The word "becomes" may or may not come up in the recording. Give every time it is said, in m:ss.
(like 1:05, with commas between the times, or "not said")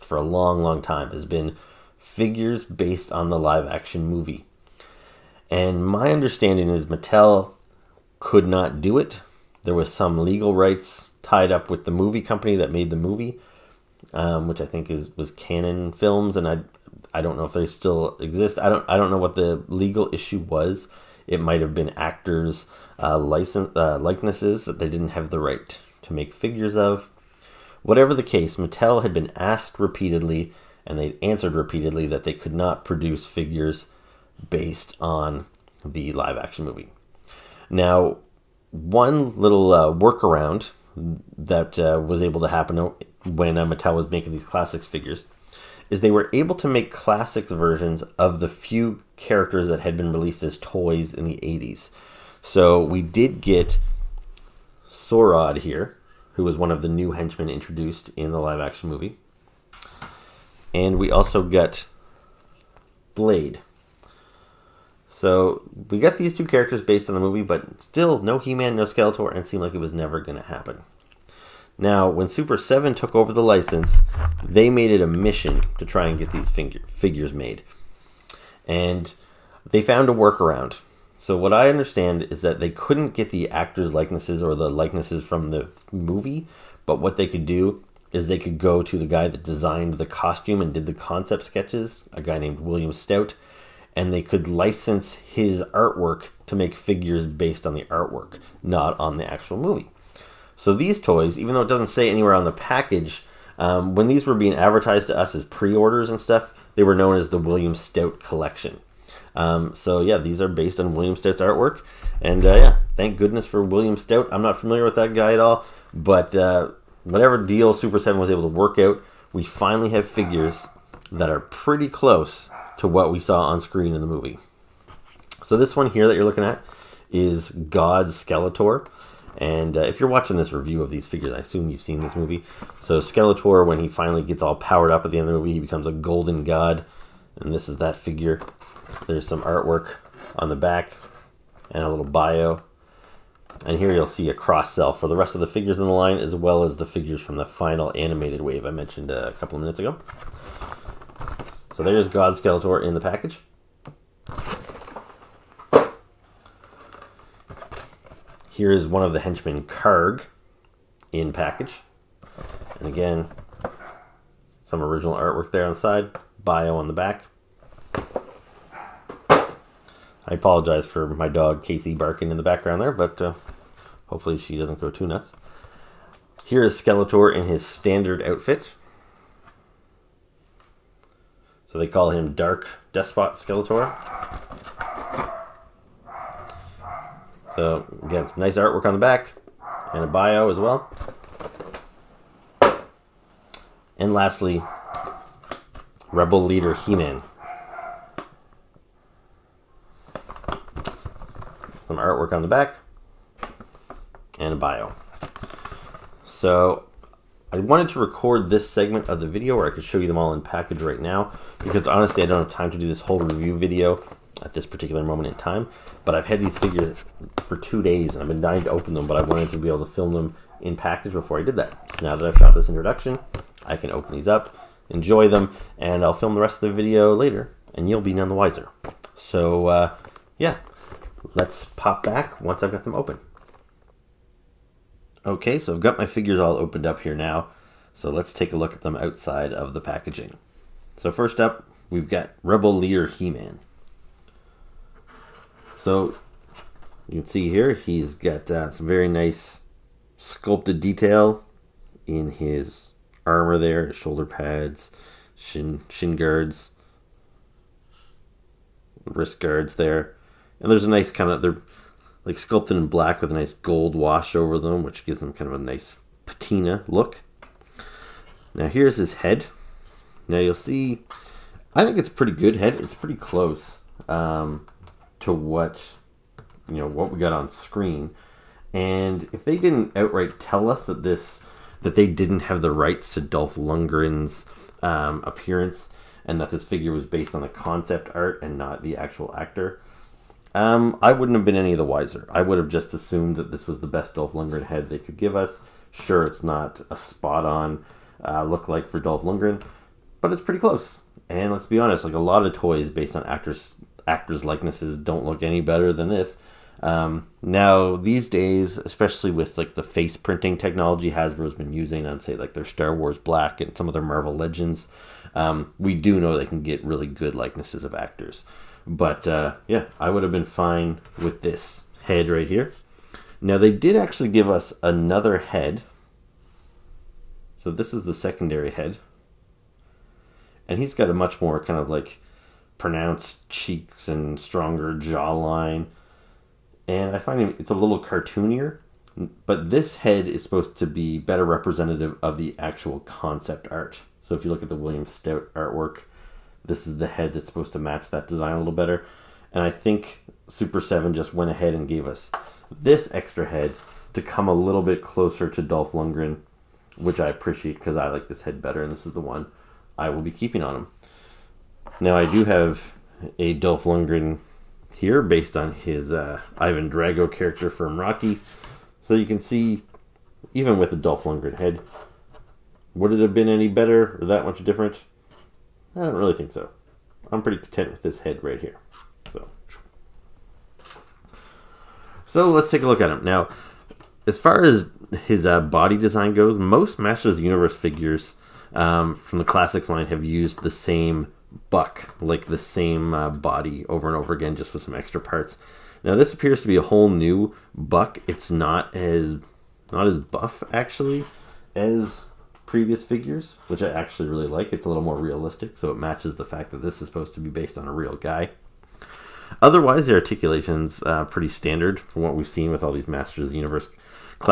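2:15.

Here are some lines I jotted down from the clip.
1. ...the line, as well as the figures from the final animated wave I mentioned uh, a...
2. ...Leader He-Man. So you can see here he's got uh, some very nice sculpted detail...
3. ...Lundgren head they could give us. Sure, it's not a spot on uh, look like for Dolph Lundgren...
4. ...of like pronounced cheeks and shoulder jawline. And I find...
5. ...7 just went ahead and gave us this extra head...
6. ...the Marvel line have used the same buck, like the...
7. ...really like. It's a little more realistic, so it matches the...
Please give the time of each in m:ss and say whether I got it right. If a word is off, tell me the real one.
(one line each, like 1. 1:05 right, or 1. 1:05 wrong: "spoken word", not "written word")
1. 2:25 right
2. 4:02 right
3. 4:54 right
4. 5:31 wrong: "stronger", not "shoulder"
5. 5:50 right
6. 6:29 wrong: "Classics", not "Marvel"
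7. 6:44 right.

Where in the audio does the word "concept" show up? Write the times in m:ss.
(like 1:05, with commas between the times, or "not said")
1:30, 4:47, 5:42.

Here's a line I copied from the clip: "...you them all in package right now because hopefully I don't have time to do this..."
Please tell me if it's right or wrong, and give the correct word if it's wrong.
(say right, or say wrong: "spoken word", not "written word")
wrong: "honestly", not "hopefully".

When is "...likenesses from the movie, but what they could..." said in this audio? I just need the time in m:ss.
1:24.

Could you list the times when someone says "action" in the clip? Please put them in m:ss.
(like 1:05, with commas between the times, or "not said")
0:03, 0:36, 0:58.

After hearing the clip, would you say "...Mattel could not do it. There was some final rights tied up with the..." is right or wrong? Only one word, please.
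wrong.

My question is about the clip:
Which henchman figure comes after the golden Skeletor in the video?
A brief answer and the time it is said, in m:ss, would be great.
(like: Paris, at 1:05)
Karg, at 2:39.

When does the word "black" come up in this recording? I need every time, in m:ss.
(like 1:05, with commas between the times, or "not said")
4:22, 5:13.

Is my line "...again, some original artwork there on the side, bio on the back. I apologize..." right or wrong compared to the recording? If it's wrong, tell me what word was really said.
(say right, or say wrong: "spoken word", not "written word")
right.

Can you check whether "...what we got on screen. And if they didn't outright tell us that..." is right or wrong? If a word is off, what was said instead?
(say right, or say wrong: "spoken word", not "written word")
right.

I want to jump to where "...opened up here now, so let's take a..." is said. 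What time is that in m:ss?
3:56.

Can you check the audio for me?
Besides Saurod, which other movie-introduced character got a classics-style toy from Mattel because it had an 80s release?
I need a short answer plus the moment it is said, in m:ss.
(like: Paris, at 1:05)
Blade, at 1:03.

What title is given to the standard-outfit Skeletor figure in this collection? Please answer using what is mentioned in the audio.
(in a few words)
Dark Despot Skeletor.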